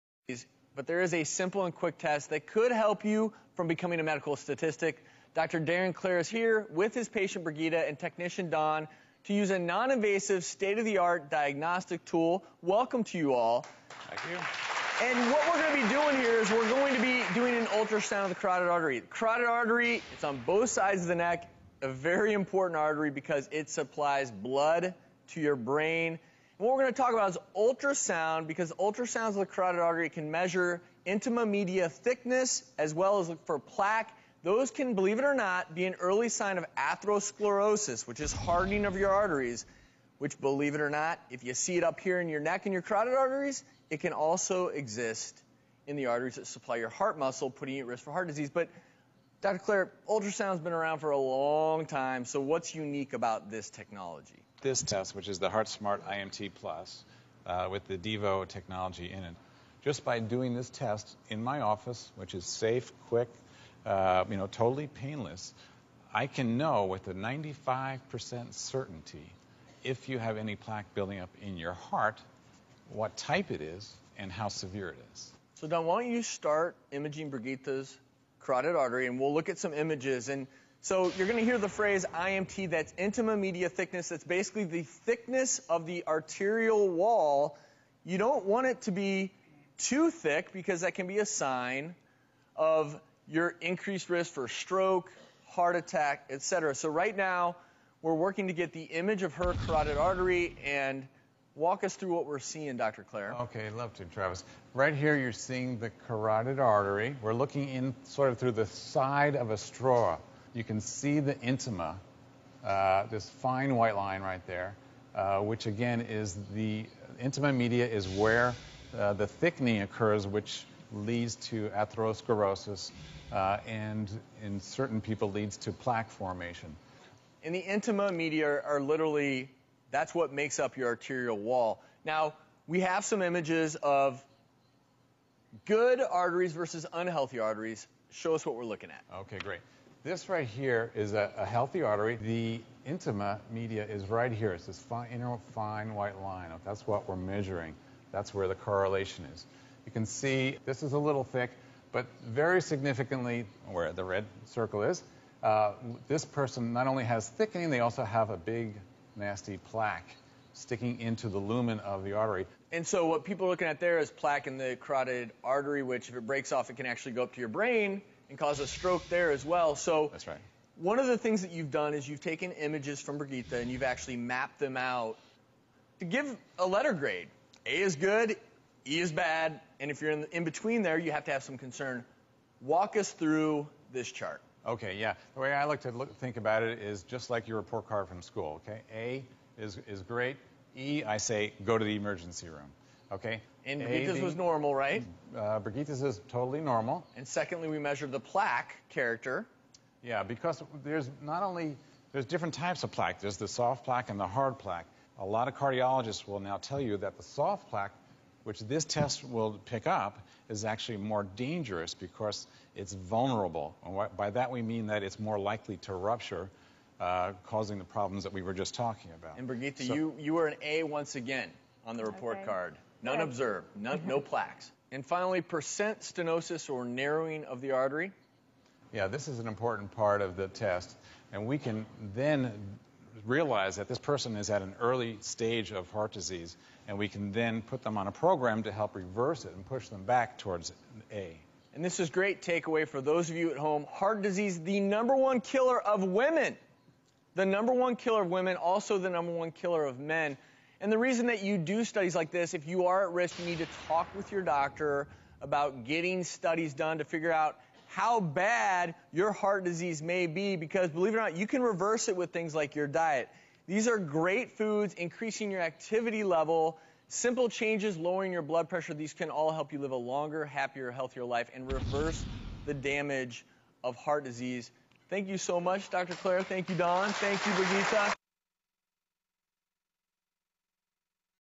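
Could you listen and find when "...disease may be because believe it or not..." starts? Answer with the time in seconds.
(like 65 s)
259 s.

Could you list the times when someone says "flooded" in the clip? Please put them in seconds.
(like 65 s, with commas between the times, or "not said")
not said.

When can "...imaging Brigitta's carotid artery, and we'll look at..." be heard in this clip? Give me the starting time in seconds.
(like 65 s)
76 s.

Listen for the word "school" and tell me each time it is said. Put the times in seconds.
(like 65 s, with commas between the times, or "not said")
188 s.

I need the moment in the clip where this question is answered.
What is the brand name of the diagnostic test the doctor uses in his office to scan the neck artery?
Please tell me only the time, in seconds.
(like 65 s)
55 s.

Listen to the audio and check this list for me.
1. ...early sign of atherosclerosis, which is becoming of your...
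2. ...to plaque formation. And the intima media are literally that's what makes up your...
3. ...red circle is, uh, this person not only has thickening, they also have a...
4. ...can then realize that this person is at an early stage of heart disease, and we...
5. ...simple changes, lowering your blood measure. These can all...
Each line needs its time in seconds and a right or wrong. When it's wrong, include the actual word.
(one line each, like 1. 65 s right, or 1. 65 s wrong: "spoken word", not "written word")
1. 35 s wrong: "hardening", not "becoming"
2. 125 s right
3. 154 s right
4. 231 s right
5. 267 s wrong: "pressure", not "measure".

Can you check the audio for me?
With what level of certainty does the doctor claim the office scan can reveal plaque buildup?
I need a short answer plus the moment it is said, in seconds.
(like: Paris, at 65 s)
95%, at 67 s.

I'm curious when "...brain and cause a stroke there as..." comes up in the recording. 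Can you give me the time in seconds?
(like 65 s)
167 s.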